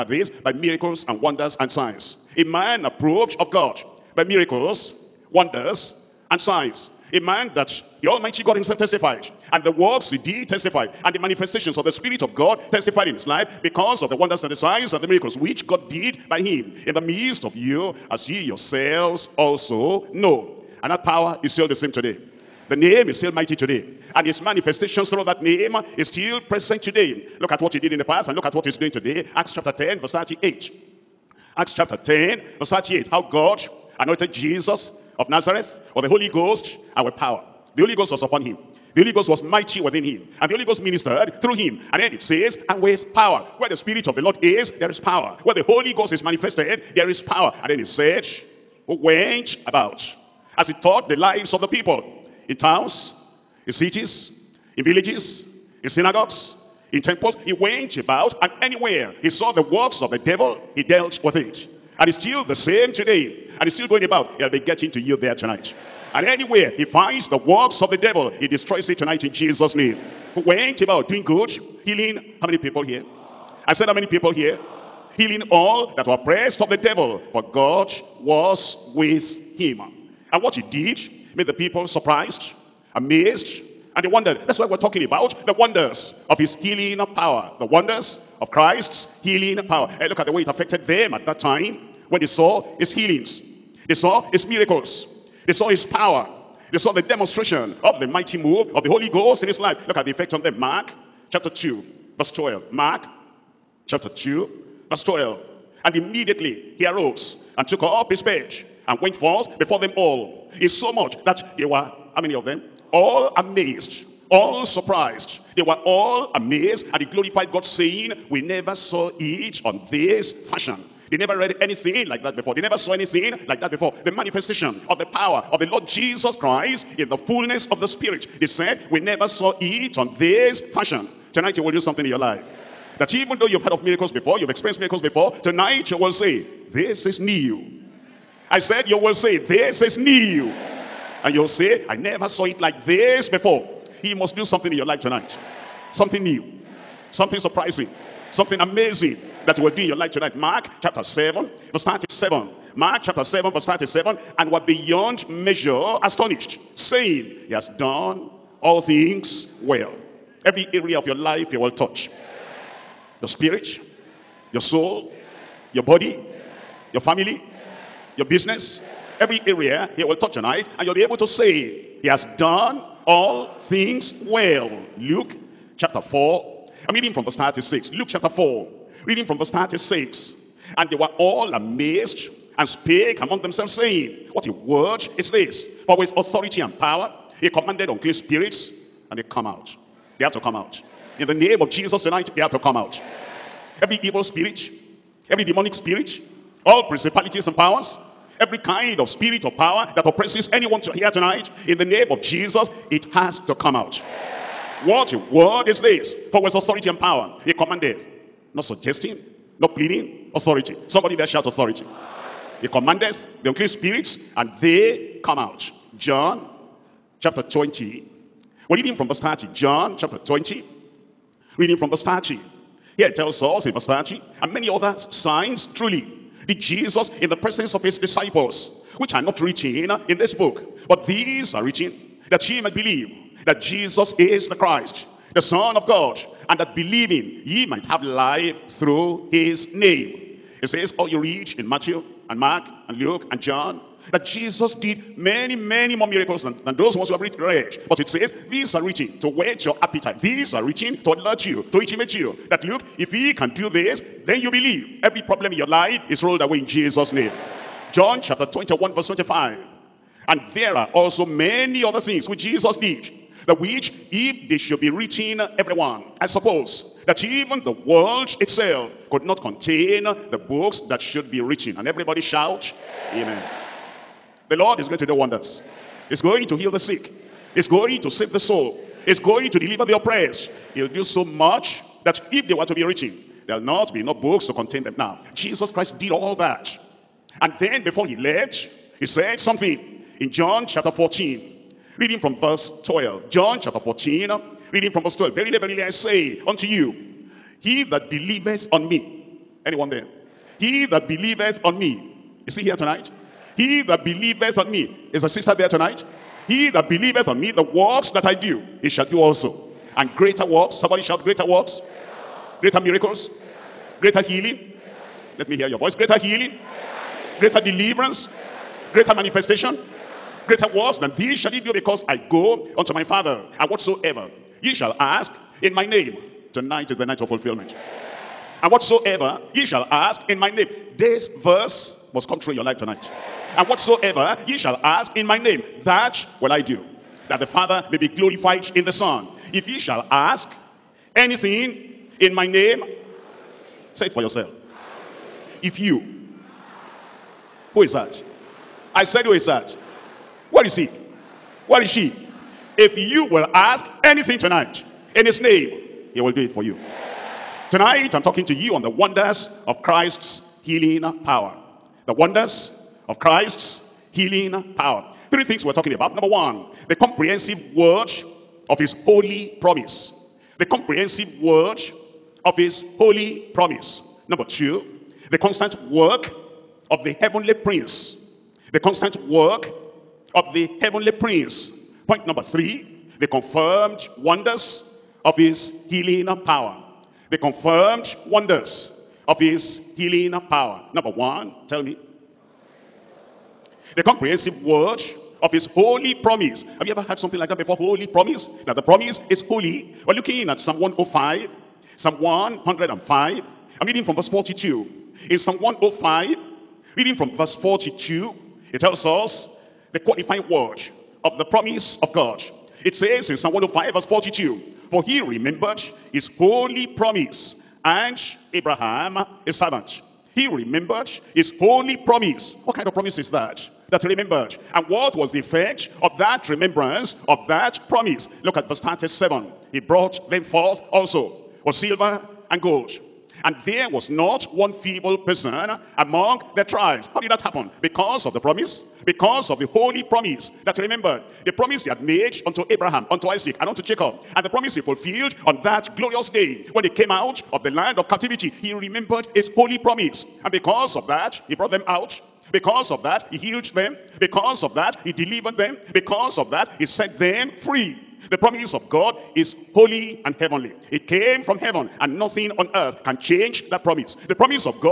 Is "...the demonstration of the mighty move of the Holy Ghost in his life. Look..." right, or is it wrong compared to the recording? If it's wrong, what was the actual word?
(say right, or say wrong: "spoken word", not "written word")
right.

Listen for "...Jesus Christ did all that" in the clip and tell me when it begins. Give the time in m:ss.
4:45.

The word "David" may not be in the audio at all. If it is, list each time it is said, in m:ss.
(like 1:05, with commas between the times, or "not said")
not said.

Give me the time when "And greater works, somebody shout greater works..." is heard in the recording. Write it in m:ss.
5:09.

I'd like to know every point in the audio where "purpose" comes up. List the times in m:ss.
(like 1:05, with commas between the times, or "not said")
not said.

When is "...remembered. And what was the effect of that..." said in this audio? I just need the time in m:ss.
7:04.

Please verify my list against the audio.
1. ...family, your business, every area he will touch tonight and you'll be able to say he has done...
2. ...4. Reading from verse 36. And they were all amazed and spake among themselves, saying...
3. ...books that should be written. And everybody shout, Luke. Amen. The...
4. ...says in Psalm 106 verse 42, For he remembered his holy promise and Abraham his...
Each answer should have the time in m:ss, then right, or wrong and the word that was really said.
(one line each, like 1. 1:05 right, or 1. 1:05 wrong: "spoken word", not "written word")
1. 2:47 right
2. 2:58 right
3. 4:30 wrong: "Amen", not "Luke"
4. 6:52 wrong: "105", not "106".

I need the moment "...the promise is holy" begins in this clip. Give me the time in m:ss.
6:38.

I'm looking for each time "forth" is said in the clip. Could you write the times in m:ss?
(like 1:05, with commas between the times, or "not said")
1:49, 7:10.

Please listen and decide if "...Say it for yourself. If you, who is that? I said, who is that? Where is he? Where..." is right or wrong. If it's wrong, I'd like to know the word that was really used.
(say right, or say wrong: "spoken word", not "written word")
right.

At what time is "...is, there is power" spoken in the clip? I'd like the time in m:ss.
0:44.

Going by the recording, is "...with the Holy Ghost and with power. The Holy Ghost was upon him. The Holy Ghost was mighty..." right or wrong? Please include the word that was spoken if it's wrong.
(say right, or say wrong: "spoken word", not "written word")
right.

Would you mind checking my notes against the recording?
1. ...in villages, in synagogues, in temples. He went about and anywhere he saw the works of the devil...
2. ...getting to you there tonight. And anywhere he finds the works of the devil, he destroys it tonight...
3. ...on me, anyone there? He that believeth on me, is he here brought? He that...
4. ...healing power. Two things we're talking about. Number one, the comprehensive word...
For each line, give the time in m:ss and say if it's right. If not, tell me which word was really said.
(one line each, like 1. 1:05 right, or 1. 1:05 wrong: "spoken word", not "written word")
1. 0:54 right
2. 1:04 right
3. 4:58 wrong: "tonight", not "brought"
4. 6:04 wrong: "Three", not "Two".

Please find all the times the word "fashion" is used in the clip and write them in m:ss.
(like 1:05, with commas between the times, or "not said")
2:00, 2:10.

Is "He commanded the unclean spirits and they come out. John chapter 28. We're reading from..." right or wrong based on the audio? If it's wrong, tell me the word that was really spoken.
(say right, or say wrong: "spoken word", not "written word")
wrong: "20", not "28".